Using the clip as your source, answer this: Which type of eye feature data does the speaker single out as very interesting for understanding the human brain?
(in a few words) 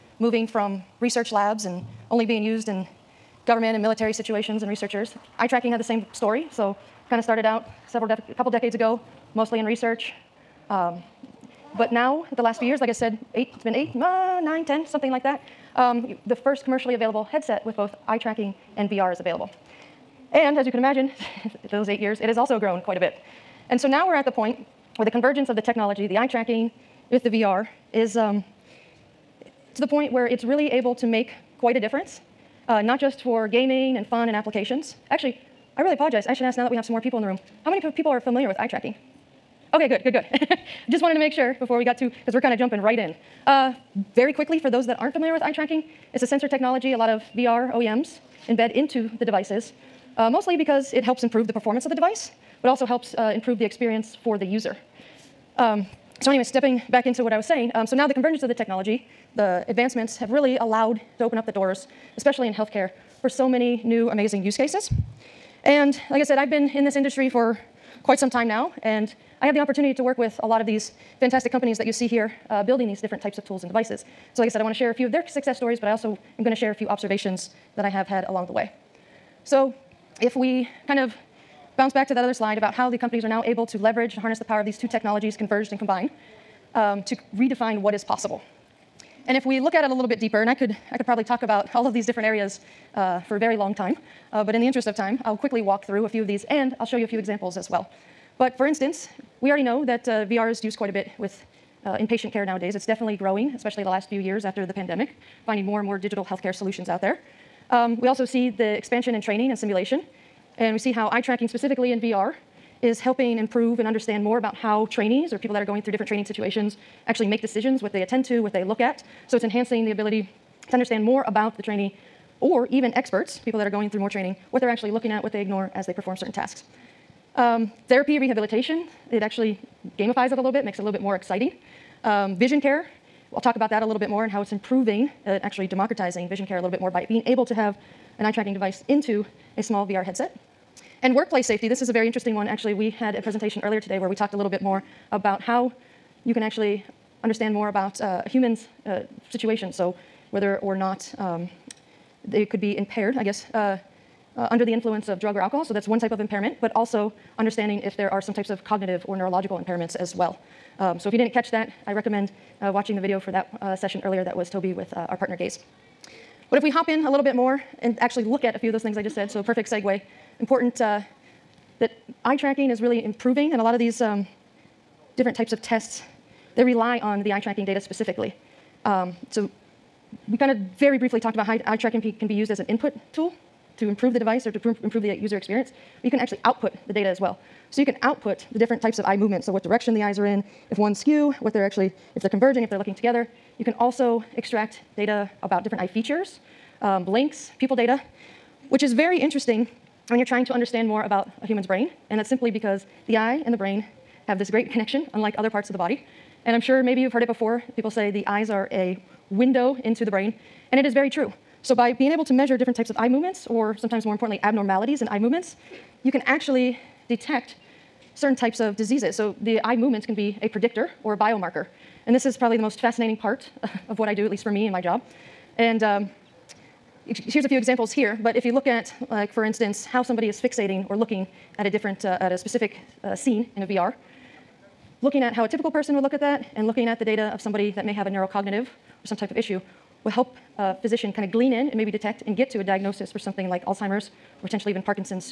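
pupil data.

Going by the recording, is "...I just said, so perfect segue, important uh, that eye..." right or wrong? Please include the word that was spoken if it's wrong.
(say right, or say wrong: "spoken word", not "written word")
right.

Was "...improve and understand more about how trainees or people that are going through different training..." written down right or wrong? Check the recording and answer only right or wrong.
right.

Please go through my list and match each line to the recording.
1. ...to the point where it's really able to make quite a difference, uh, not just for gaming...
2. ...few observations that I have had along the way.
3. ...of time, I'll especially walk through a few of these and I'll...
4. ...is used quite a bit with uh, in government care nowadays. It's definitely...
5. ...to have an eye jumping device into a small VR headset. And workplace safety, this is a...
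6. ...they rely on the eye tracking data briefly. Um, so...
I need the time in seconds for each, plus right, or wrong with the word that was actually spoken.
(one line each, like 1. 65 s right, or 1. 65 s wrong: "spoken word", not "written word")
1. 29 s right
2. 76 s right
3. 94 s wrong: "quickly", not "especially"
4. 100 s wrong: "patient", not "government"
5. 137 s wrong: "tracking", not "jumping"
6. 176 s wrong: "specifically", not "briefly".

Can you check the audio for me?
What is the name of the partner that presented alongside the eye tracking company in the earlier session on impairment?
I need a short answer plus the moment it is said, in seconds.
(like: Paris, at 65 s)
Gaze, at 165 s.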